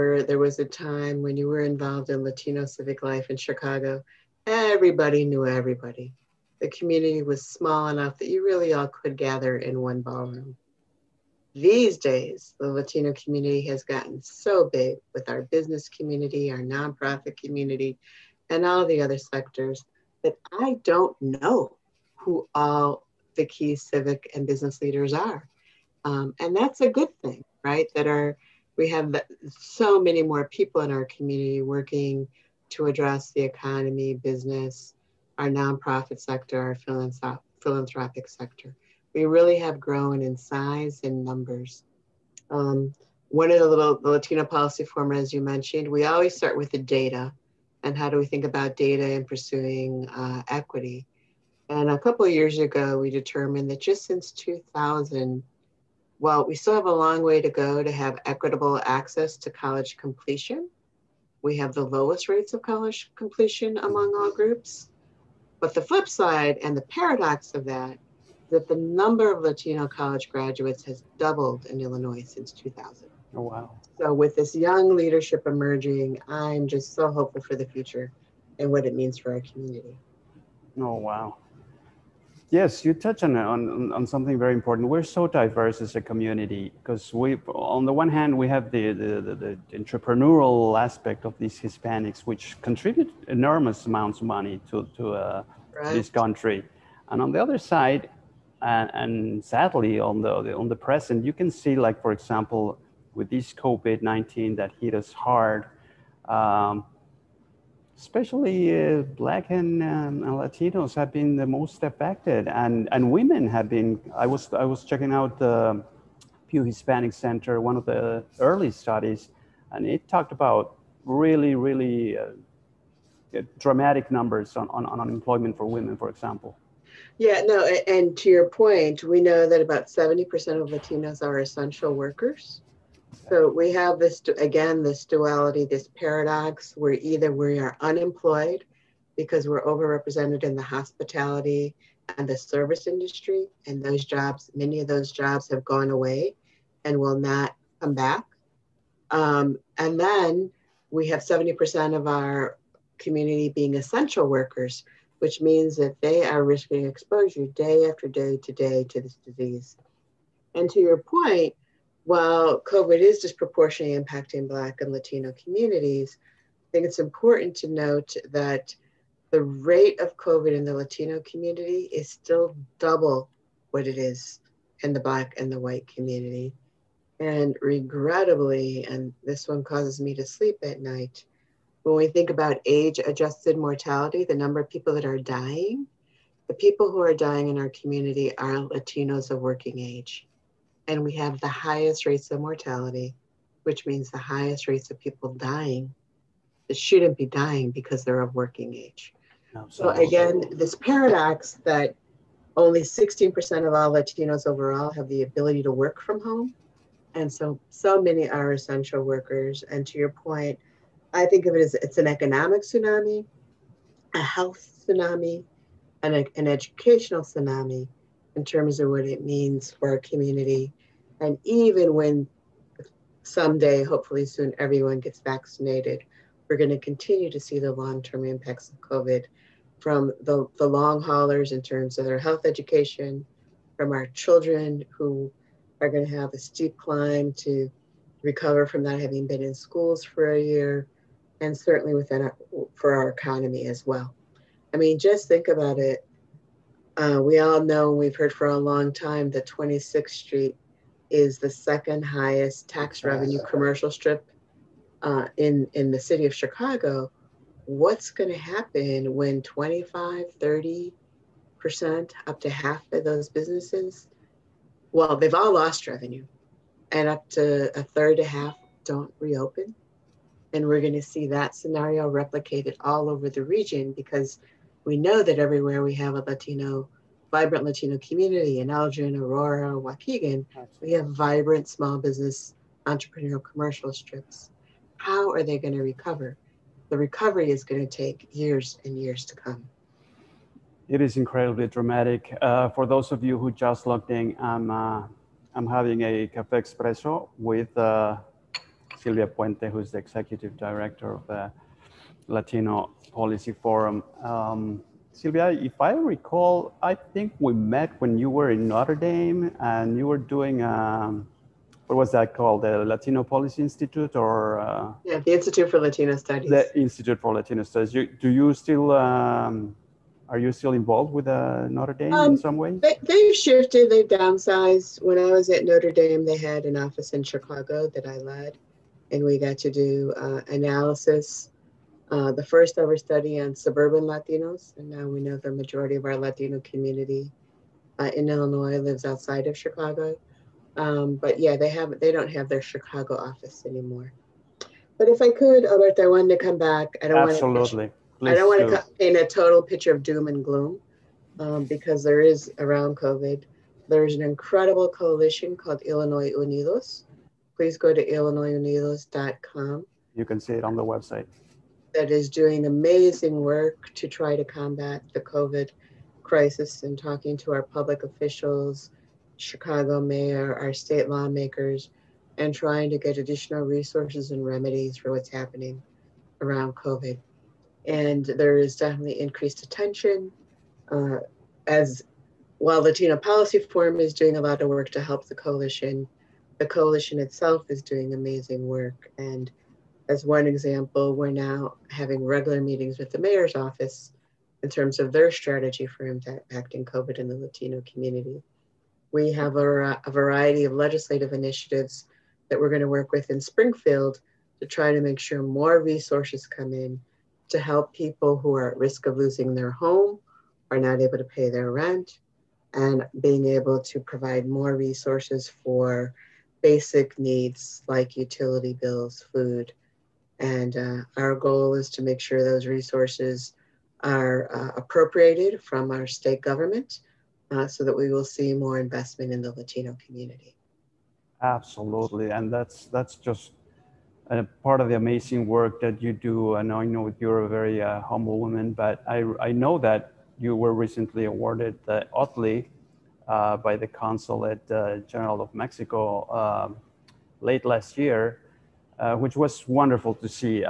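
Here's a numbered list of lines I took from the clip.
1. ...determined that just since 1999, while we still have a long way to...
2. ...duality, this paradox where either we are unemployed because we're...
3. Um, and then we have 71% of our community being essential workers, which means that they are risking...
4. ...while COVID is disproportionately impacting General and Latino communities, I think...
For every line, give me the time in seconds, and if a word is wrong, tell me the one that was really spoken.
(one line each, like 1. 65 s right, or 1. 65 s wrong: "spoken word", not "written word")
1. 53 s wrong: "2000", not "1999"
2. 135 s right
3. 149 s wrong: "70", not "71"
4. 162 s wrong: "Black", not "General".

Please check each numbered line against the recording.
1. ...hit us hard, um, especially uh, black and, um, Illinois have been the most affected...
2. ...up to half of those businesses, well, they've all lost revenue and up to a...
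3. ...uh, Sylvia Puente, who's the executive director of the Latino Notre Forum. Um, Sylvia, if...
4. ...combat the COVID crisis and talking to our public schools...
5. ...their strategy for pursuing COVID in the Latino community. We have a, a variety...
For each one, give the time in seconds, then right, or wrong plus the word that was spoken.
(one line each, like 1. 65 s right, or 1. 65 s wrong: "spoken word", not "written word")
1. 104 s wrong: "Latinos", not "Illinois"
2. 262 s right
3. 297 s wrong: "Policy", not "Notre"
4. 364 s wrong: "officials", not "schools"
5. 395 s wrong: "impacting", not "pursuing".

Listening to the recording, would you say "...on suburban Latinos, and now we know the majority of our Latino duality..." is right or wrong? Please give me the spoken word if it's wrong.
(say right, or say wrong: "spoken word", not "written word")
wrong: "community", not "duality".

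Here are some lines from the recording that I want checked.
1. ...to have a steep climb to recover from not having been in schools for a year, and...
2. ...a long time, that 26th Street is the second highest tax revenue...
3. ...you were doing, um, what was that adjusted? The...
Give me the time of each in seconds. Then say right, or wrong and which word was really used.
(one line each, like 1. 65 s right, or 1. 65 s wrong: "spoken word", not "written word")
1. 236 s right
2. 248 s right
3. 309 s wrong: "called", not "adjusted".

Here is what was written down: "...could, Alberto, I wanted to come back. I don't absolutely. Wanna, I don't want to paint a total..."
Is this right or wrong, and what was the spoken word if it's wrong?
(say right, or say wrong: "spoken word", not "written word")
right.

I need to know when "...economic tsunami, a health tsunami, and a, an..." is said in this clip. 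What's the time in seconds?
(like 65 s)
212 s.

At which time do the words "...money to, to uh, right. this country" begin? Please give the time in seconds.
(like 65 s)
94 s.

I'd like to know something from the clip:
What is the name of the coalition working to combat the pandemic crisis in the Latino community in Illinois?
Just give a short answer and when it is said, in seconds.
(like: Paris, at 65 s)
Illinois Unidos, at 355 s.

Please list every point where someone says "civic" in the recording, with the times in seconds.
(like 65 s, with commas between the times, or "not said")
2 s, 23 s.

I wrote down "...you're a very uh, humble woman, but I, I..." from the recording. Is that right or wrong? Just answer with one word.
right.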